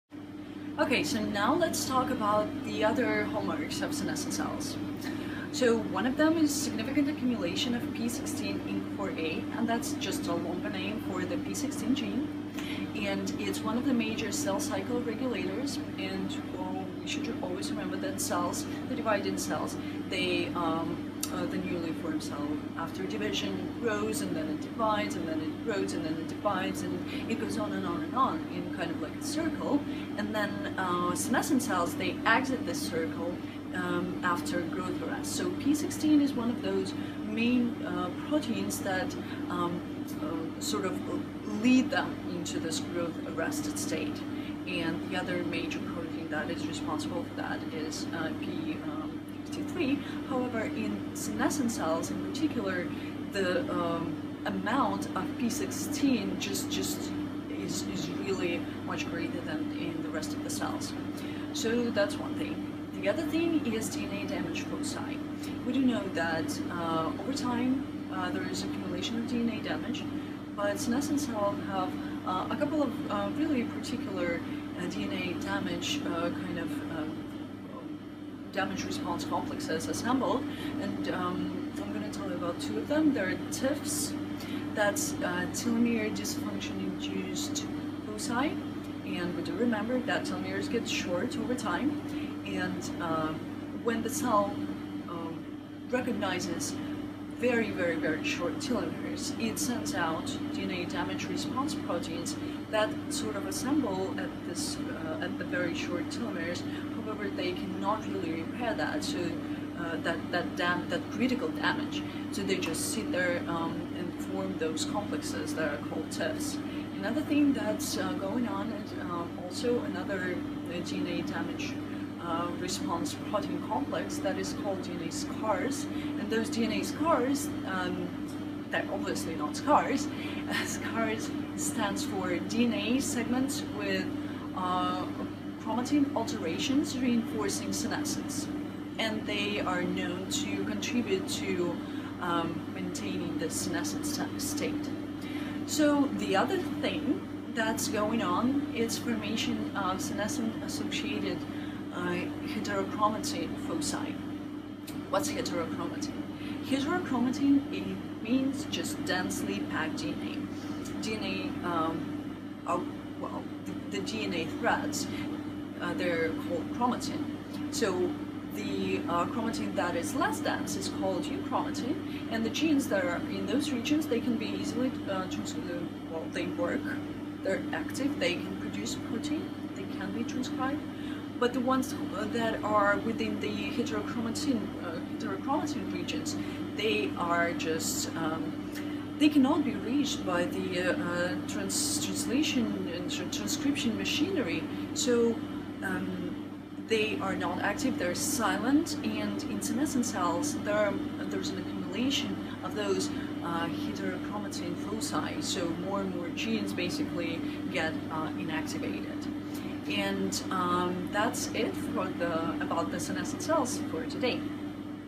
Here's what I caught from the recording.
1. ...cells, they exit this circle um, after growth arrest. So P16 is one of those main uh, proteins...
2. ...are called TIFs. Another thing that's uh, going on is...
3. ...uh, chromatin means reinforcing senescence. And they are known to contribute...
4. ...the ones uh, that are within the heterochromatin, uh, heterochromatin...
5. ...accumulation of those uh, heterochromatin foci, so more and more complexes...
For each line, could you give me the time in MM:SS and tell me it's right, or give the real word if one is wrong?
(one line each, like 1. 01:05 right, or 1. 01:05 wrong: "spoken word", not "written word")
1. 00:31 right
2. 01:55 right
3. 02:14 wrong: "alterations", not "means"
4. 03:01 right
5. 03:21 wrong: "genes", not "complexes".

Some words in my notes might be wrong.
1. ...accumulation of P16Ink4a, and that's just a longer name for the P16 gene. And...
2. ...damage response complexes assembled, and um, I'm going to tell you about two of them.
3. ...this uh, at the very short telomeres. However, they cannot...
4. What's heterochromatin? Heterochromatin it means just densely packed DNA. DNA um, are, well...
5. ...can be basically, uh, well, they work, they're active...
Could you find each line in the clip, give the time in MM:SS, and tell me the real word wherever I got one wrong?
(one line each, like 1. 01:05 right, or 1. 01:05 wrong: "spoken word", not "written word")
1. 00:07 right
2. 01:18 right
3. 01:44 right
4. 02:35 right
5. 02:54 wrong: "easily", not "basically".